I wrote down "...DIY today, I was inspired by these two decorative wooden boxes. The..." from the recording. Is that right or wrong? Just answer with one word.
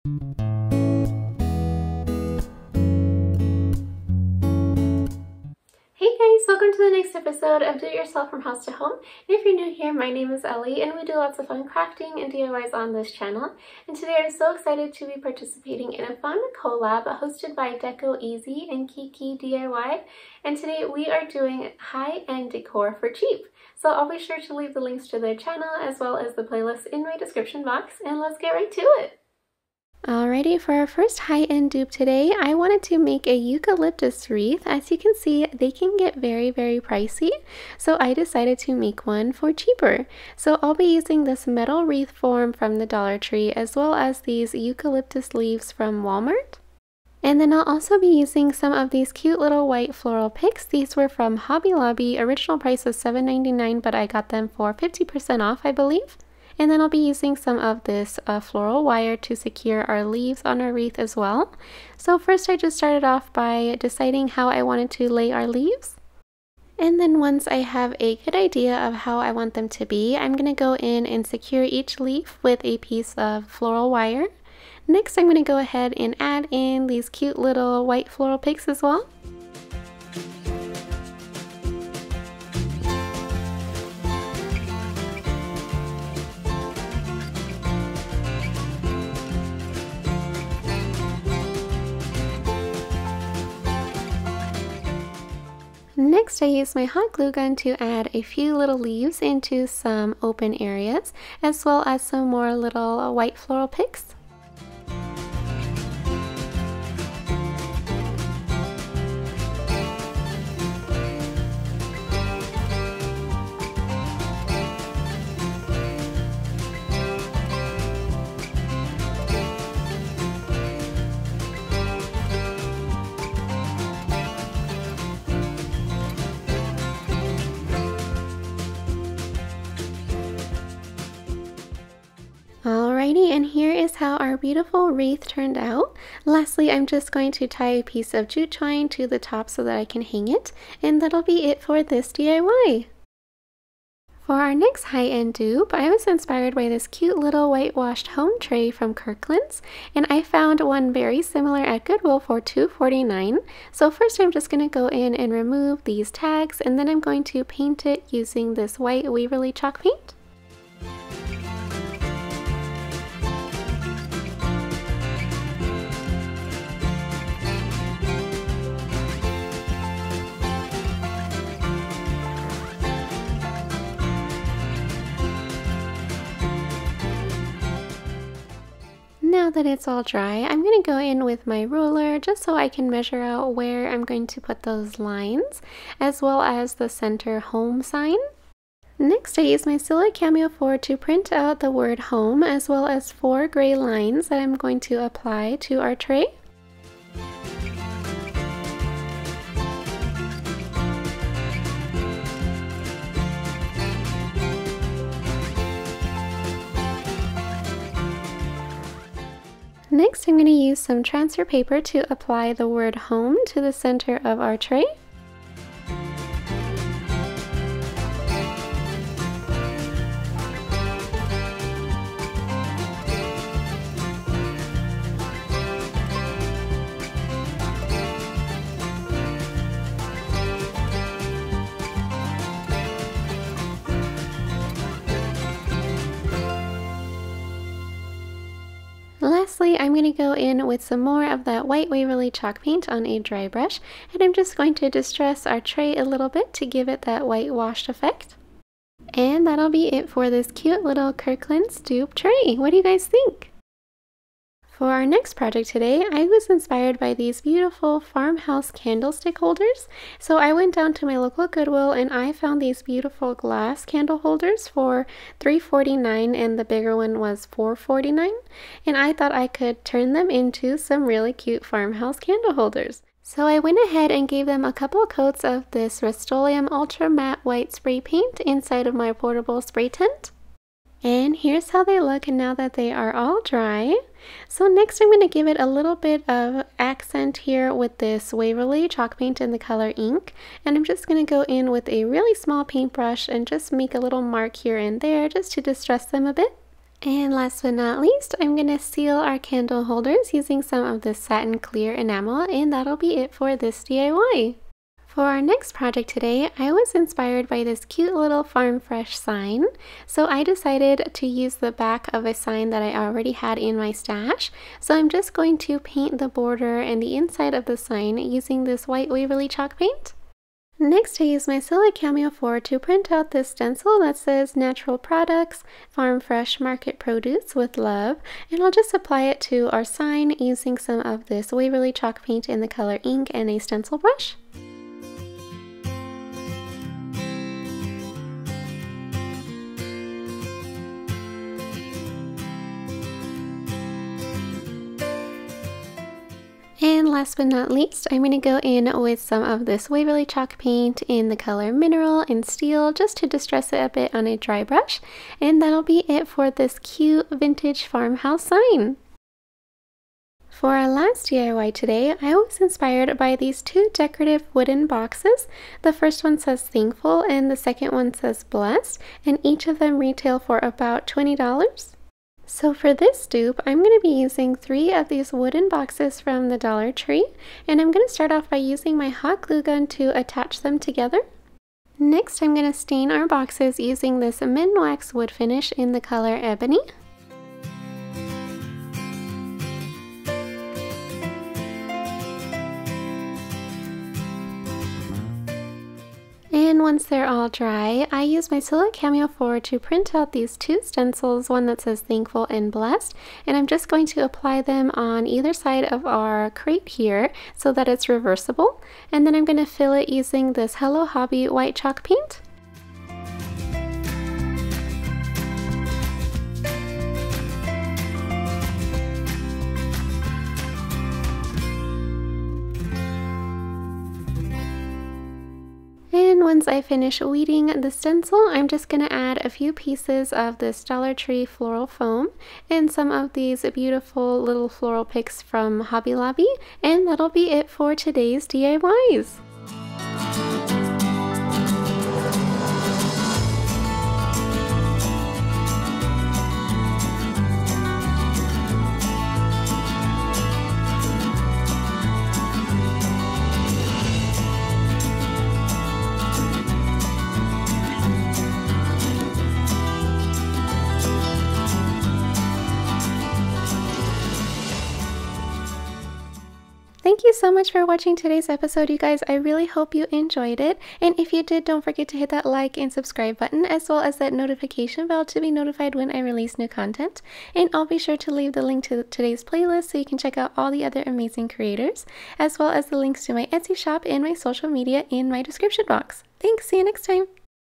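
right.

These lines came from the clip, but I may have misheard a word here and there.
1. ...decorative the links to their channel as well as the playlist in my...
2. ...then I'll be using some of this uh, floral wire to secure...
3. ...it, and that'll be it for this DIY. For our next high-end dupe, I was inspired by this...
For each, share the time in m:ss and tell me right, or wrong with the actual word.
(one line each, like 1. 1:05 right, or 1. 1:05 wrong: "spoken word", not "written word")
1. 0:24 wrong: "leave", not "decorative"
2. 0:56 right
3. 2:20 right.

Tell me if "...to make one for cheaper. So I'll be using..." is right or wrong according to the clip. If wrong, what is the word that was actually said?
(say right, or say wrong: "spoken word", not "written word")
right.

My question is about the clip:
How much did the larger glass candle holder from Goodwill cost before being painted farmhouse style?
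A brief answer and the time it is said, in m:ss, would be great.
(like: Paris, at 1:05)
$4.49, at 4:27.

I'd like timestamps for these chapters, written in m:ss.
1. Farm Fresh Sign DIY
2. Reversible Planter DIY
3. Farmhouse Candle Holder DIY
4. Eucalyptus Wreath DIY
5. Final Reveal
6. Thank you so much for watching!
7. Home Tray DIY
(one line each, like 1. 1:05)
1. 5:05
2. 6:00
3. 4:14
4. 0:29
5. 7:20
6. 7:46
7. 2:23.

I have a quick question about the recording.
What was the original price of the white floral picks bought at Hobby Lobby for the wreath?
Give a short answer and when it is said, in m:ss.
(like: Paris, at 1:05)
$7.99, at 0:52.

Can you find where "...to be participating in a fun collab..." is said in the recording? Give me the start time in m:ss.
0:14.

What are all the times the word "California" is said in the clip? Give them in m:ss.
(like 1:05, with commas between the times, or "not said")
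not said.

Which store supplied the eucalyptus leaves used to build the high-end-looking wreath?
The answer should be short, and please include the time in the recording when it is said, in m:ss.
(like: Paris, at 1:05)
Walmart, at 0:46.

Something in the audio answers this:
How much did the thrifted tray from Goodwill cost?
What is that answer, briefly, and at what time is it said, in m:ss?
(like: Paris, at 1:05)
$2.49, at 2:32.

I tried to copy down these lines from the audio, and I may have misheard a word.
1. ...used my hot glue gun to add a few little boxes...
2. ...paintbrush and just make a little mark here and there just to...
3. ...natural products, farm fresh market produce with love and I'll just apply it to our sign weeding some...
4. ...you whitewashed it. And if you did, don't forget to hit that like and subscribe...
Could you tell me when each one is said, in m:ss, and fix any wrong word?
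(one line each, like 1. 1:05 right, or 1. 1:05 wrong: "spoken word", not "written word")
1. 1:36 wrong: "leaves", not "boxes"
2. 4:52 right
3. 5:24 wrong: "using", not "weeding"
4. 7:49 wrong: "enjoyed", not "whitewashed".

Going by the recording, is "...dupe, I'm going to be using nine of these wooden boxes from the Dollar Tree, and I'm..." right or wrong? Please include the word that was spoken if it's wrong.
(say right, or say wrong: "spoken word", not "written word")
wrong: "three", not "nine".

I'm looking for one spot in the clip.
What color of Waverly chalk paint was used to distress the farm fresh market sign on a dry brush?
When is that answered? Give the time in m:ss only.
5:51.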